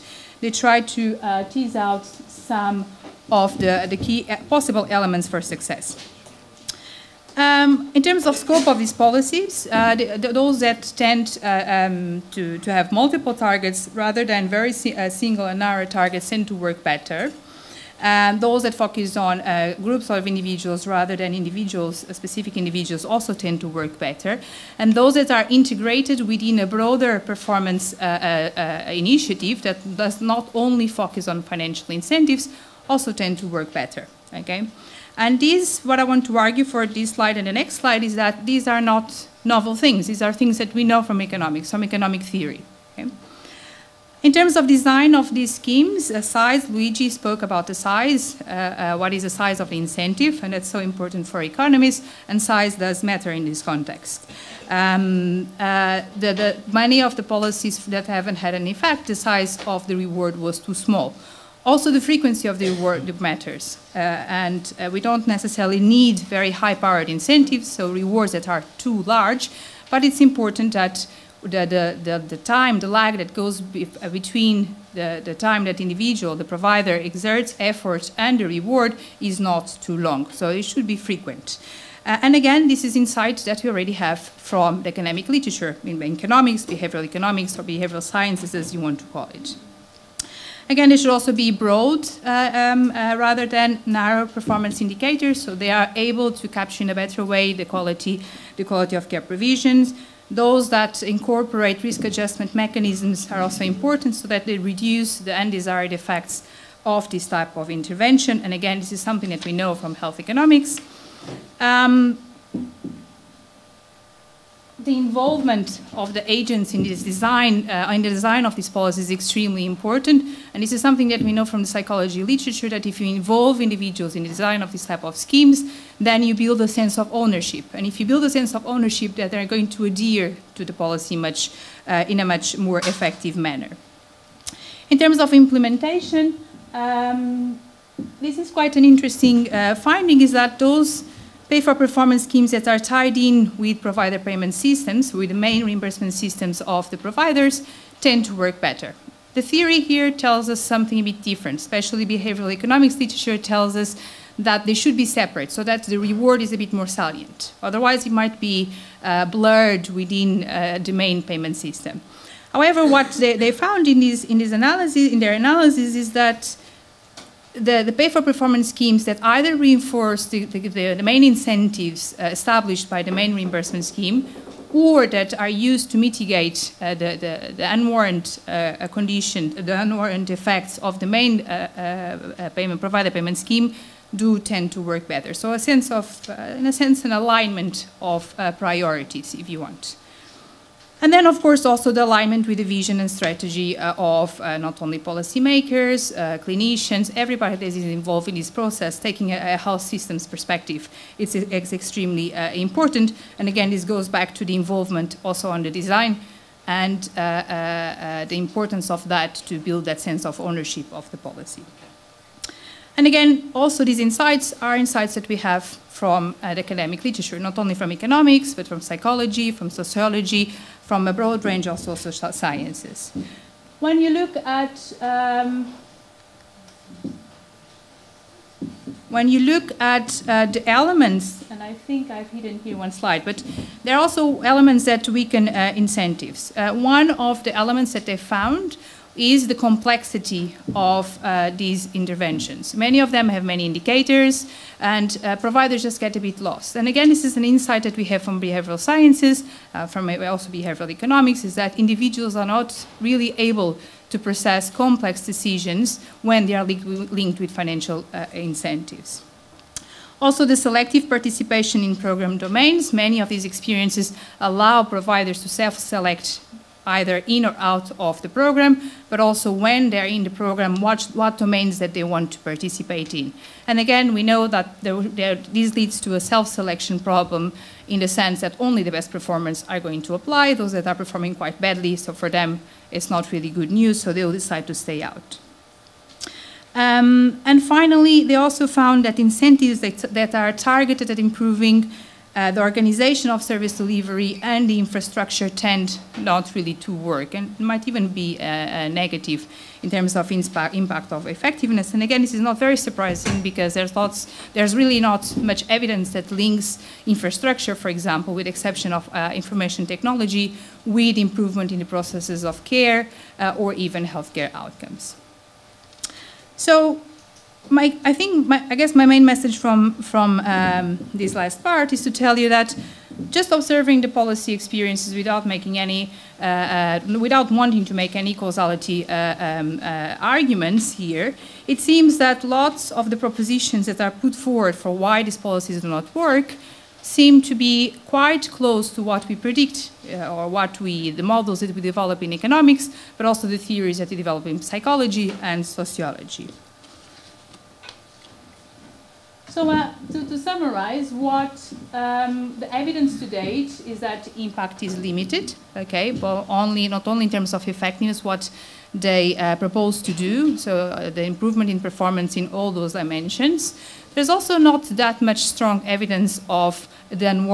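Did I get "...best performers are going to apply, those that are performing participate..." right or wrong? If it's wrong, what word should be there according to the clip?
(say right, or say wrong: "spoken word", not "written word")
wrong: "quite", not "participate".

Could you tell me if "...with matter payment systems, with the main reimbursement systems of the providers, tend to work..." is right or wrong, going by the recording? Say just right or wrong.
wrong.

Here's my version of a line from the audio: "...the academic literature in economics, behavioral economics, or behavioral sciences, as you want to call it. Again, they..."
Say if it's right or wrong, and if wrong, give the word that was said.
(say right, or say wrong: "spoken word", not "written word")
right.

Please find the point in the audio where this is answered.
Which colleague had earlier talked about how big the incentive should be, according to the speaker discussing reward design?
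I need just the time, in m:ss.
0:46.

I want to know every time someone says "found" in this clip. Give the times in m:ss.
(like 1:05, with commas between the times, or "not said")
2:43, 3:58, 4:48.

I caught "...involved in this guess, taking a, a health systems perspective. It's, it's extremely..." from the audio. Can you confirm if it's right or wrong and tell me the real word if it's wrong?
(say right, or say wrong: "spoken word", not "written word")
wrong: "process", not "guess".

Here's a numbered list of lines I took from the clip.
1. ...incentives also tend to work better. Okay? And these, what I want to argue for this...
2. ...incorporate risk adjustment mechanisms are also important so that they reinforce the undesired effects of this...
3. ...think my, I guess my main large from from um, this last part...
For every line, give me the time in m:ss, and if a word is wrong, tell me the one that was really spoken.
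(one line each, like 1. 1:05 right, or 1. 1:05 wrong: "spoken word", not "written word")
1. 0:31 right
2. 1:41 wrong: "reduce", not "reinforce"
3. 5:18 wrong: "message", not "large".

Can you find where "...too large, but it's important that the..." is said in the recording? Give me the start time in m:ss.
1:08.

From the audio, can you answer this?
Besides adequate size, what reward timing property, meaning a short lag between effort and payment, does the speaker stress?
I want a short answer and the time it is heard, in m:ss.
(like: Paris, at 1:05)
Frequency, at 1:01.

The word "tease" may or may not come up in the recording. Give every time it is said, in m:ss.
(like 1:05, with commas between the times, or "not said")
0:01.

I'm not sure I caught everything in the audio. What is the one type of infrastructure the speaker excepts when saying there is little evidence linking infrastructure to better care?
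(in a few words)
Information technology.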